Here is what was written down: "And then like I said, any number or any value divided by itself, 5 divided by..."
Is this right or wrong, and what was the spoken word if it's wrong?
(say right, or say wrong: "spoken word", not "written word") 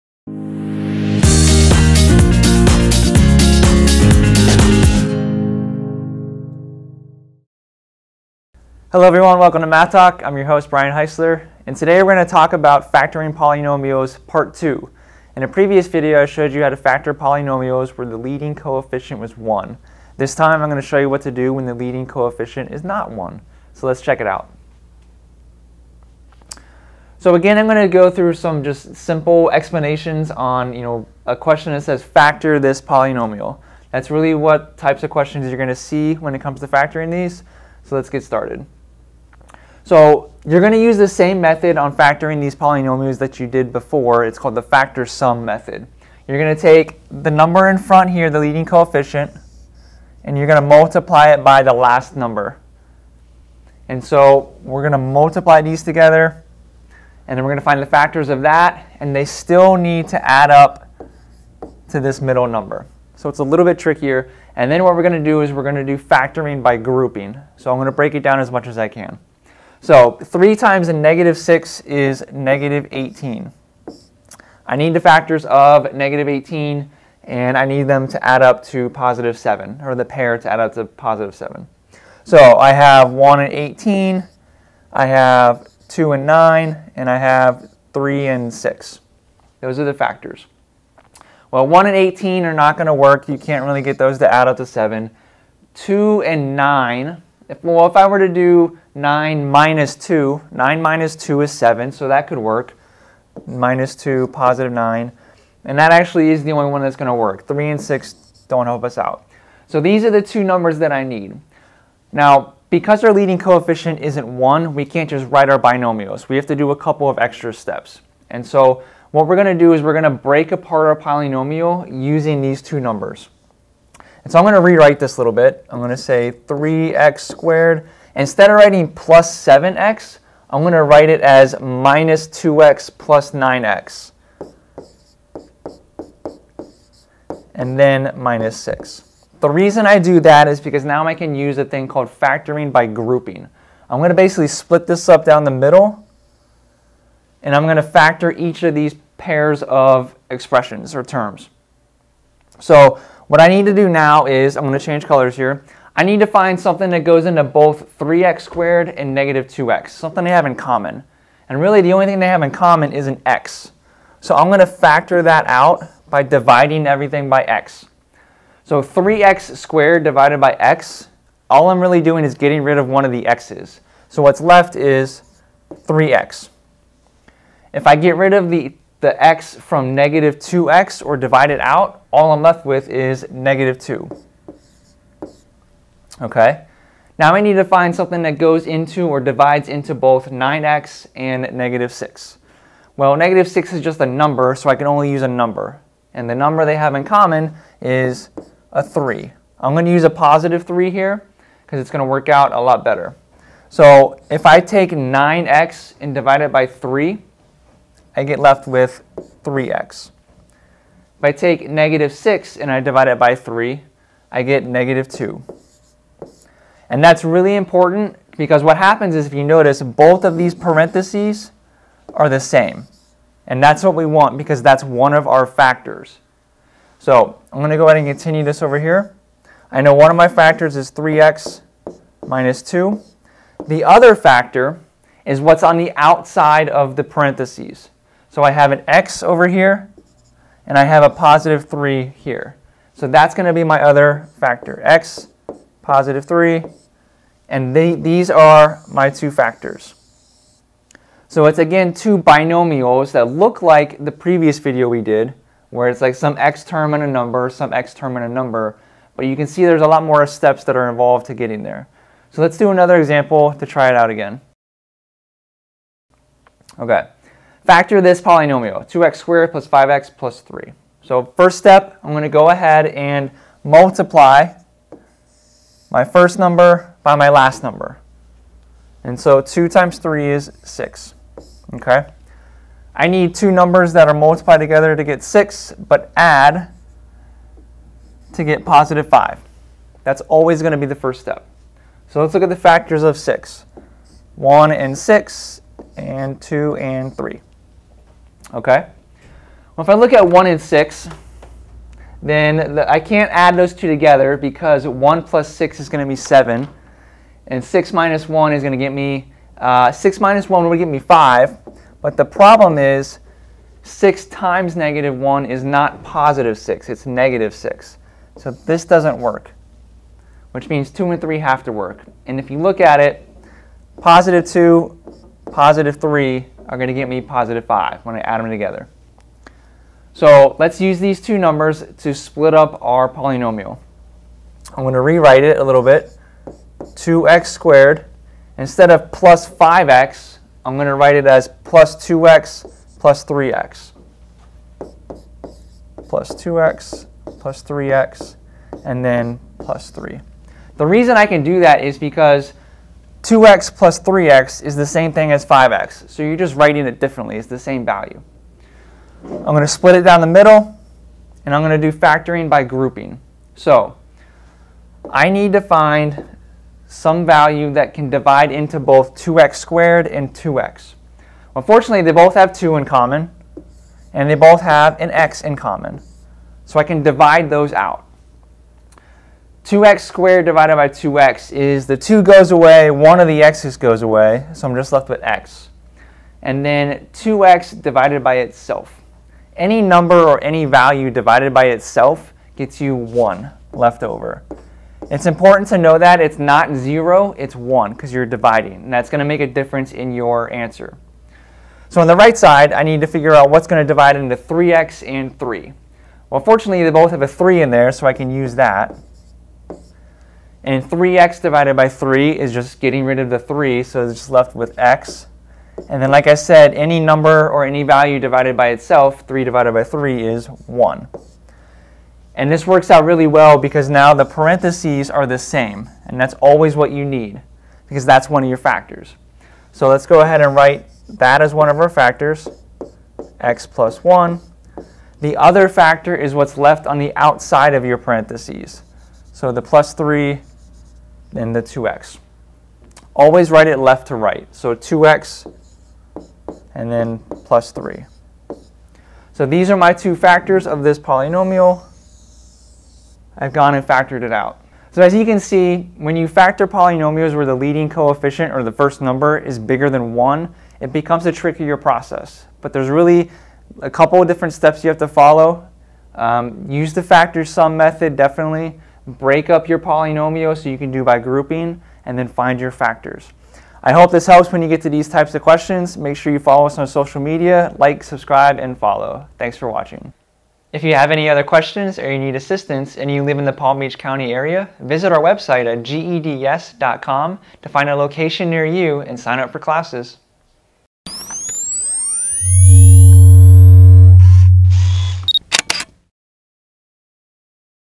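wrong: "3", not "5".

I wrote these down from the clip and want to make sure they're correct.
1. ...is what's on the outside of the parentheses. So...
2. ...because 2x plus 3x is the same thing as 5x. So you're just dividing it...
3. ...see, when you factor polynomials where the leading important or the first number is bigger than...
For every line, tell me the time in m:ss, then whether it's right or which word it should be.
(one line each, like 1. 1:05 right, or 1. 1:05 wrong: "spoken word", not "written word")
1. 3:55 right
2. 5:51 wrong: "writing", not "dividing"
3. 7:35 wrong: "coefficient", not "important".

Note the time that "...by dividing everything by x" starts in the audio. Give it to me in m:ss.
2:46.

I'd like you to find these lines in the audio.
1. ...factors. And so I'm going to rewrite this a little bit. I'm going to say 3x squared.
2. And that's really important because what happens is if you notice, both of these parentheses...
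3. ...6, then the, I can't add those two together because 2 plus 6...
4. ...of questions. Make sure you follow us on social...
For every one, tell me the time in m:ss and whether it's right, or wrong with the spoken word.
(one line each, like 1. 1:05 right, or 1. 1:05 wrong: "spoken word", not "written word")
1. 2:02 wrong: "numbers", not "factors"
2. 3:36 right
3. 5:00 wrong: "1", not "2"
4. 7:55 right.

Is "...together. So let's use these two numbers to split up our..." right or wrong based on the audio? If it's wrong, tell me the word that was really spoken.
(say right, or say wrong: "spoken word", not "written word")
right.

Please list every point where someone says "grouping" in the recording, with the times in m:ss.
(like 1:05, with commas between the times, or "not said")
1:06, 2:22, 6:02, 7:51.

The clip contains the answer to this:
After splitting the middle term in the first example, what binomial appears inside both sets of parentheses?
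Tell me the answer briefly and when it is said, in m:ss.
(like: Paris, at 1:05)
3x - 2, at 3:50.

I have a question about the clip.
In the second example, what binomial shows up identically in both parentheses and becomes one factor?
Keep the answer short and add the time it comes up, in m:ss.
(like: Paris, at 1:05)
x + 1, at 7:13.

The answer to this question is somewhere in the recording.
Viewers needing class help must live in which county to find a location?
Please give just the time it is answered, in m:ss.
8:03.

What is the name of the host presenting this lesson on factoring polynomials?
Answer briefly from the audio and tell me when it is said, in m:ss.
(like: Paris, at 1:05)
Brian Heisler, at 0:10.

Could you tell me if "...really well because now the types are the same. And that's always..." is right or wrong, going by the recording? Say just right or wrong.
wrong.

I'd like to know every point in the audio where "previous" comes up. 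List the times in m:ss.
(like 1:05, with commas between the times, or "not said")
0:15, 4:14.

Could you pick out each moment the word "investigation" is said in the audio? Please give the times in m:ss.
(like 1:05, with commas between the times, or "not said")
not said.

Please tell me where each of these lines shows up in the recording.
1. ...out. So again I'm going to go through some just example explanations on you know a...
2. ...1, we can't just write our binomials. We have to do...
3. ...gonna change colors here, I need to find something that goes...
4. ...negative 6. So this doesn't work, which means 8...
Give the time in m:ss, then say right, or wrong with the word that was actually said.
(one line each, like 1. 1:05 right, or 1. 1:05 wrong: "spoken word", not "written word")
1. 0:24 wrong: "simple", not "example"
2. 1:54 right
3. 2:34 right
4. 5:17 wrong: "2", not "8".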